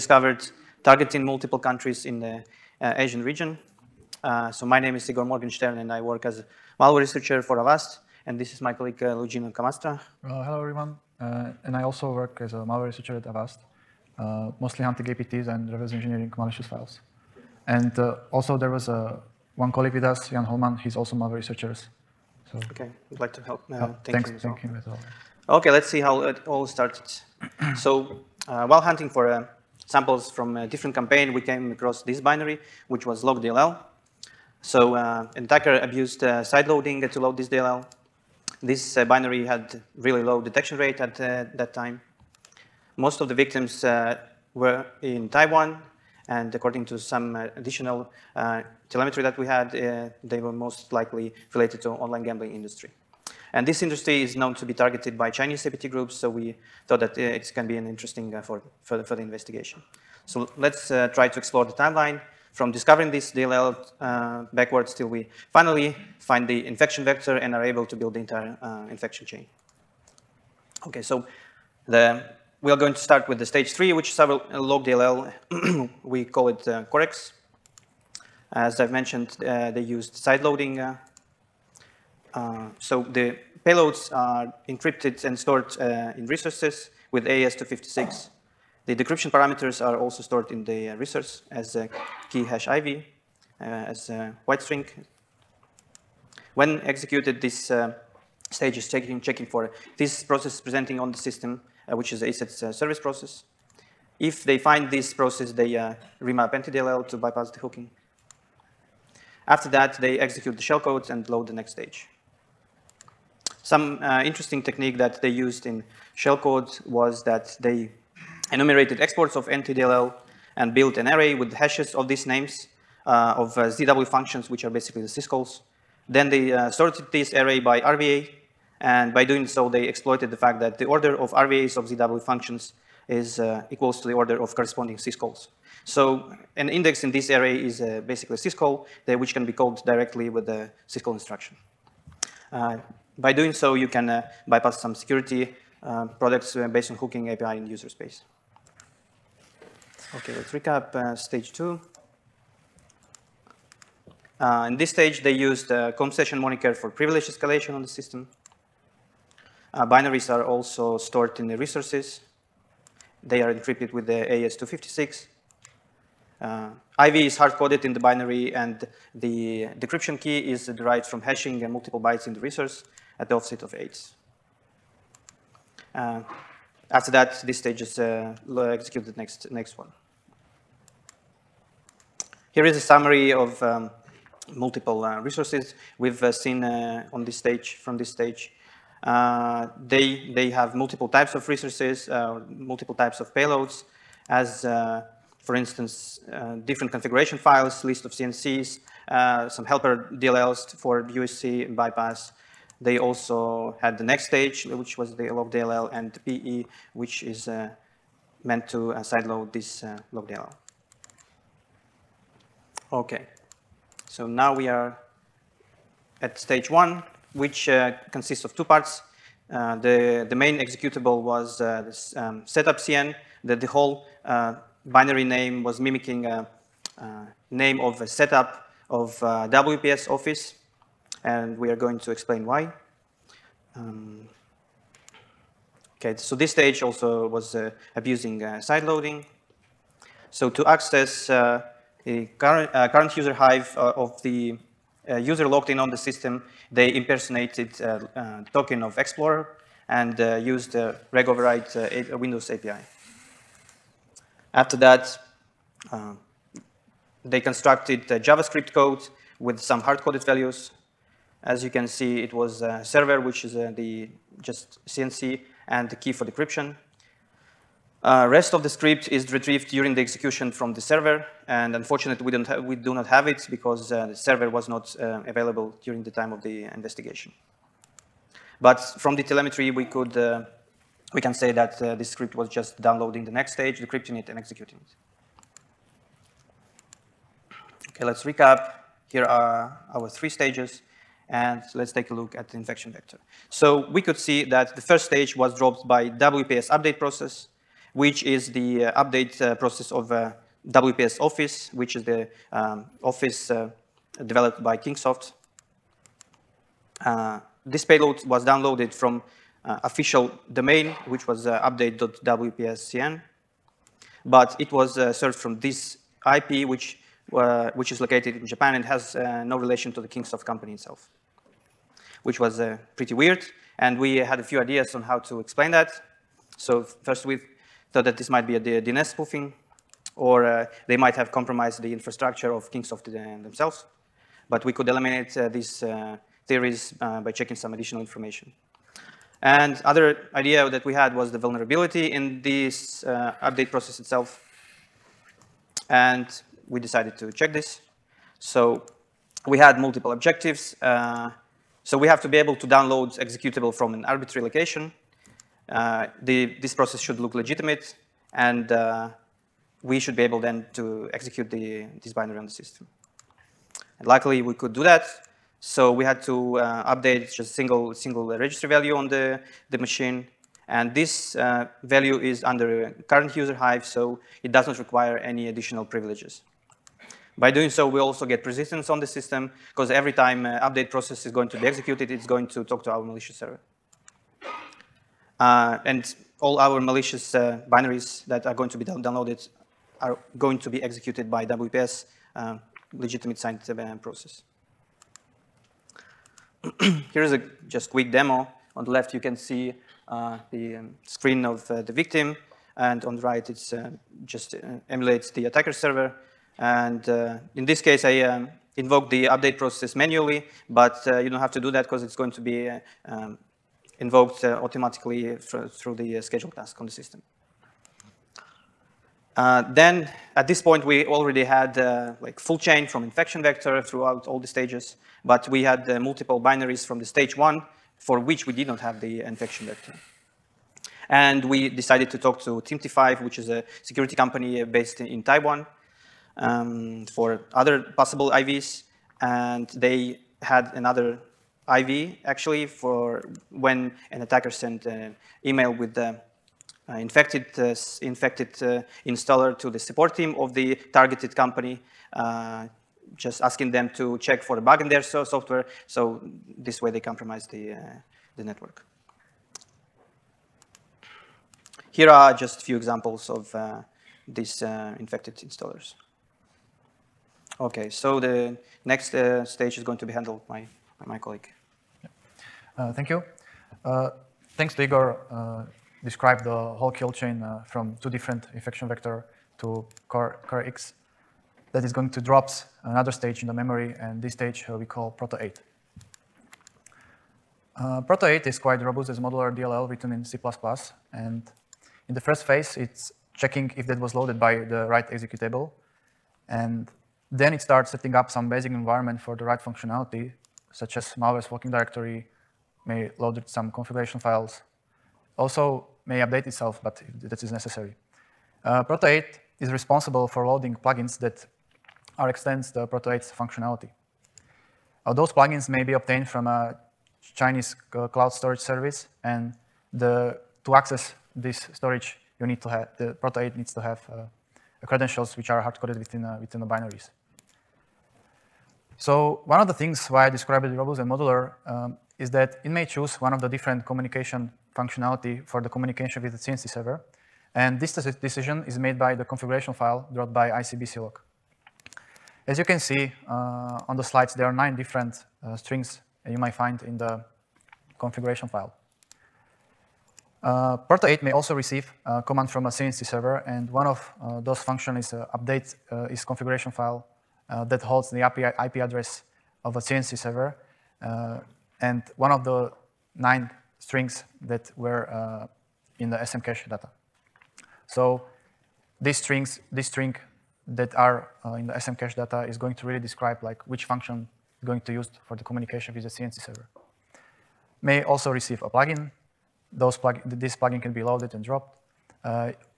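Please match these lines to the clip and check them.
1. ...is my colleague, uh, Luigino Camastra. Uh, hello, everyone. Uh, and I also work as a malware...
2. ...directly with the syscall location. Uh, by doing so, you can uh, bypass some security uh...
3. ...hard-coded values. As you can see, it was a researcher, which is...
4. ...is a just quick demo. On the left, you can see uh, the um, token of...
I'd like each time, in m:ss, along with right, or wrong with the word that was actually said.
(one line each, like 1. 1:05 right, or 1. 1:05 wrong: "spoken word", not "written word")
1. 0:08 right
2. 2:19 wrong: "instruction", not "location"
3. 4:19 wrong: "server", not "researcher"
4. 6:37 wrong: "screen", not "token".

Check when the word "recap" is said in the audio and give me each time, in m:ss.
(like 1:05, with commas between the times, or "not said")
2:30, 4:48.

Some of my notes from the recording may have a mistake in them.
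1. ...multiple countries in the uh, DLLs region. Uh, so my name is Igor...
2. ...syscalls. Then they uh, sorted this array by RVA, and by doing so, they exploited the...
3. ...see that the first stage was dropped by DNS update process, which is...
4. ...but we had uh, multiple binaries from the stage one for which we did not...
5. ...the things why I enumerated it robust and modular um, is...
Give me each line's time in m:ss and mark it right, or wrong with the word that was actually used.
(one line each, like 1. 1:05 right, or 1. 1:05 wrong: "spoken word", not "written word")
1. 0:01 wrong: "Asian", not "DLLs"
2. 2:05 right
3. 4:54 wrong: "WPS", not "DNS"
4. 7:05 right
5. 8:49 wrong: "described", not "enumerated".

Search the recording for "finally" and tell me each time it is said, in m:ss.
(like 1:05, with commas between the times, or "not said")
1:05.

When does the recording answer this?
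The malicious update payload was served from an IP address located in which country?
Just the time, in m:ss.
5:18.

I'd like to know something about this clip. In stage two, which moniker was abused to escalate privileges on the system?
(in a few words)
session moniker.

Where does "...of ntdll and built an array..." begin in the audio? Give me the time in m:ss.
1:59.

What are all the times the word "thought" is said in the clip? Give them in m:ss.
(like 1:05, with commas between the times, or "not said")
0:56, 5:27.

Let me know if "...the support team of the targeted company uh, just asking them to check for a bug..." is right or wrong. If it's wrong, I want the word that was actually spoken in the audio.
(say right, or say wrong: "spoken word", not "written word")
right.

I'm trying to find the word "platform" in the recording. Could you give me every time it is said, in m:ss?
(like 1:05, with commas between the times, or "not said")
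not said.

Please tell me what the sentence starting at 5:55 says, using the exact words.
Uh, the, this process should look legitimate and uh, we should be able then to execute the, this binary on the system.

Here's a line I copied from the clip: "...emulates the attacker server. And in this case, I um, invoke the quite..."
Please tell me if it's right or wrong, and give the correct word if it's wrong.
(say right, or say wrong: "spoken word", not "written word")
wrong: "update", not "quite".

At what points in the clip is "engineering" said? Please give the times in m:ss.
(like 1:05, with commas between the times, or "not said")
0:15.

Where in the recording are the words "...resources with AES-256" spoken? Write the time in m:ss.
1:26.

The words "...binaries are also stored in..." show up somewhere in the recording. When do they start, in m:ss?
2:39.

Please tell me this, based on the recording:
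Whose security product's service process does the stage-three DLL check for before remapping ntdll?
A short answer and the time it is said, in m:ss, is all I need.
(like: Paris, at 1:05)
ESET, at 1:42.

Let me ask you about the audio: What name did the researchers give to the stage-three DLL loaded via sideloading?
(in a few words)
Corex.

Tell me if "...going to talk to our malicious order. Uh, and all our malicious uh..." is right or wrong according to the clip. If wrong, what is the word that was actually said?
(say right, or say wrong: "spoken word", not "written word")
wrong: "server", not "order".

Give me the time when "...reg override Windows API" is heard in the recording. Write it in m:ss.
4:11.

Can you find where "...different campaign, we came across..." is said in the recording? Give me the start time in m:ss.
0:30.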